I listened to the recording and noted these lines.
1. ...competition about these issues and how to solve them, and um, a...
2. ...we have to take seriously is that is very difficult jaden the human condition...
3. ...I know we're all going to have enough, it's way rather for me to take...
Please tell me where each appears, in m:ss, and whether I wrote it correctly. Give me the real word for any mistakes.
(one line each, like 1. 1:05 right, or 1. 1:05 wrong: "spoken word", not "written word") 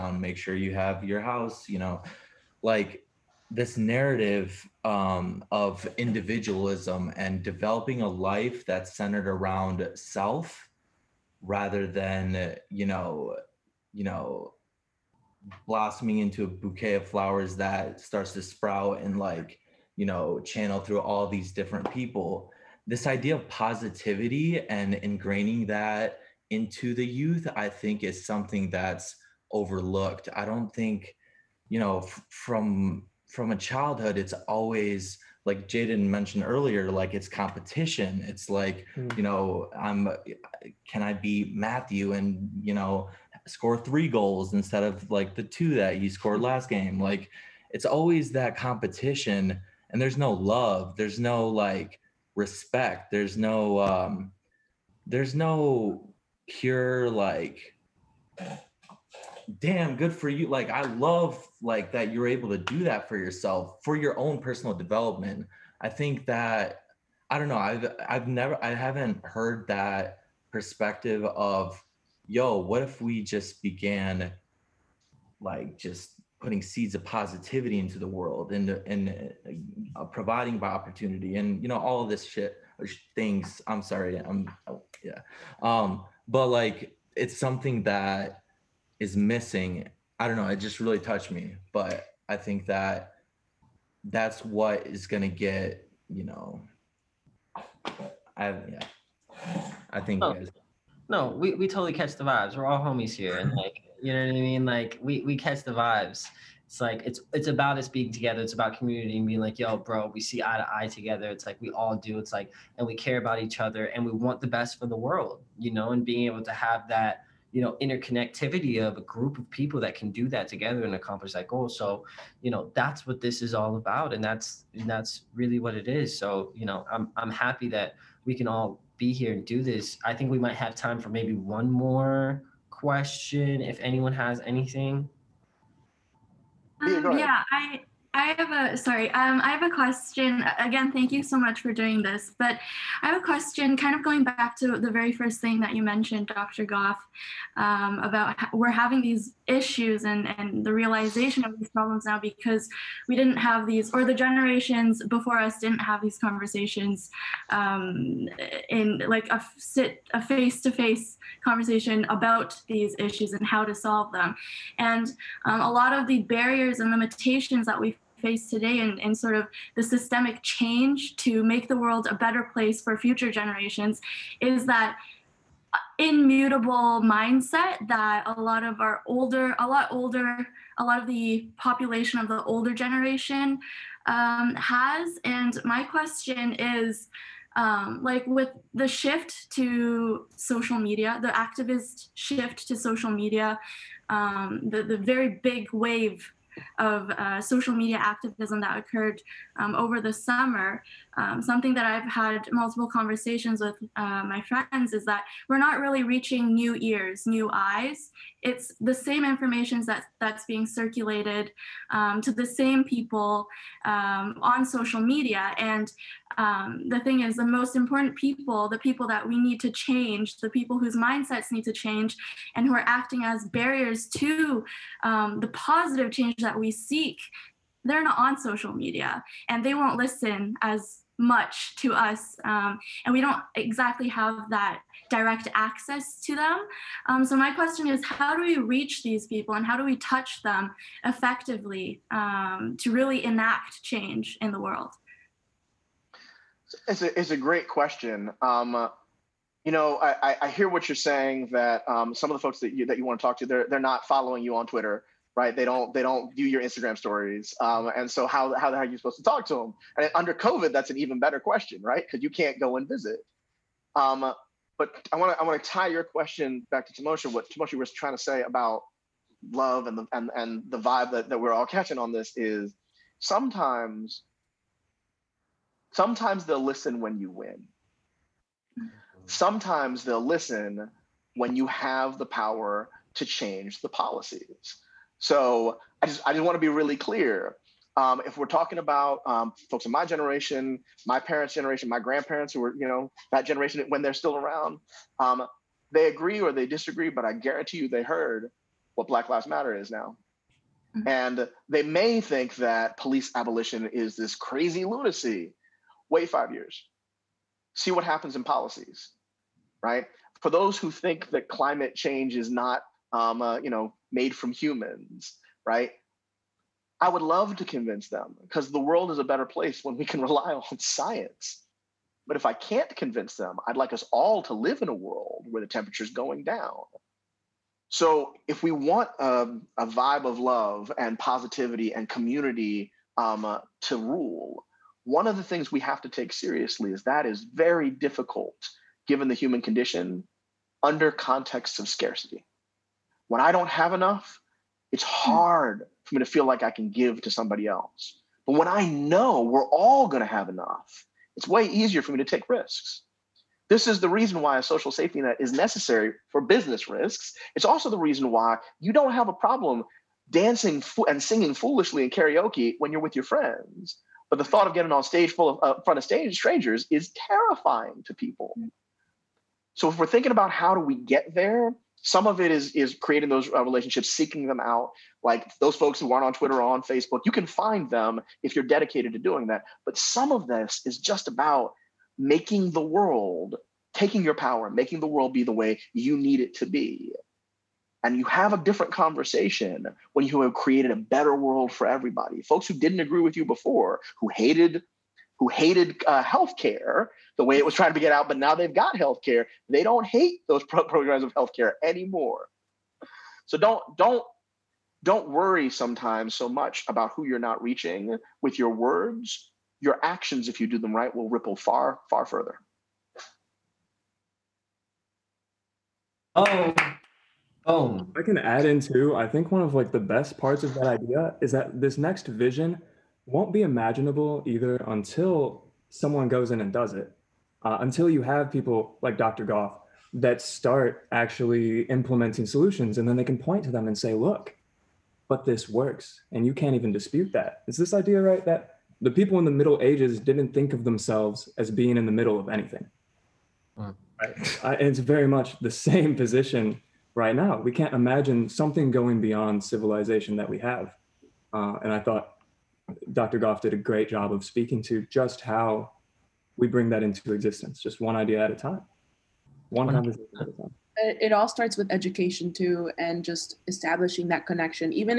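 1. 2:41 wrong: "conversation", not "competition"
2. 5:35 wrong: "given", not "jaden"
3. 5:48 wrong: "easier", not "rather".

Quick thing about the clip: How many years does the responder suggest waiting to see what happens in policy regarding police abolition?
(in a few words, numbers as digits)
5.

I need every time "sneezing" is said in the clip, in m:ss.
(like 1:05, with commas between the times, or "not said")
not said.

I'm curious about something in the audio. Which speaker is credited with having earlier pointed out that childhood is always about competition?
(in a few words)
Jaden.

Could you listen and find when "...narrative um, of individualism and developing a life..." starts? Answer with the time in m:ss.
0:03.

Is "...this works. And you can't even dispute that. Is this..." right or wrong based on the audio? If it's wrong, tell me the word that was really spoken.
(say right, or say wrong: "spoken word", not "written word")
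right.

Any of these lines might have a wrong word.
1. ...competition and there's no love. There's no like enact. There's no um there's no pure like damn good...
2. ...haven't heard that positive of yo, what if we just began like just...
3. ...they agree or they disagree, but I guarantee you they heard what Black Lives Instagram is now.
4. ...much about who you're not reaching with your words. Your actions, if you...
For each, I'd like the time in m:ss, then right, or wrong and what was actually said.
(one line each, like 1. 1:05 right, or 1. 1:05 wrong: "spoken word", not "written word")
1. 0:48 wrong: "respect", not "enact"
2. 1:08 wrong: "perspective", not "positive"
3. 4:55 wrong: "Matter", not "Instagram"
4. 6:46 right.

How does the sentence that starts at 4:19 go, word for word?
And under COVID, that's an even better question, right?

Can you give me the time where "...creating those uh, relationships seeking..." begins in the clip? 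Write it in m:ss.
6:12.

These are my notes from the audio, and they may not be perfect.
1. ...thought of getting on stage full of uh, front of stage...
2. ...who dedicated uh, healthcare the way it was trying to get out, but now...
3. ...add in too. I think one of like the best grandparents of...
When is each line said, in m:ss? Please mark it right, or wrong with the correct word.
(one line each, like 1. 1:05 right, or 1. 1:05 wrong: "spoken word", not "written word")
1. 6:04 right
2. 6:35 wrong: "hated", not "dedicated"
3. 6:58 wrong: "parts", not "grandparents".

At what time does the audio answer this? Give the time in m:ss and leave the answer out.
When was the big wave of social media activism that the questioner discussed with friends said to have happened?
3:19.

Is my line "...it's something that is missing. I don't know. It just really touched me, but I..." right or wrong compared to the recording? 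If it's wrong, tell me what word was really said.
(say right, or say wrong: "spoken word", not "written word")
right.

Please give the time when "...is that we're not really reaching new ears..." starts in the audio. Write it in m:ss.
3:24.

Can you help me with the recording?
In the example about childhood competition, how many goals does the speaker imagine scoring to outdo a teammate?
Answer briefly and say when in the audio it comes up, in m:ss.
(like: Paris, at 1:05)
3, at 0:43.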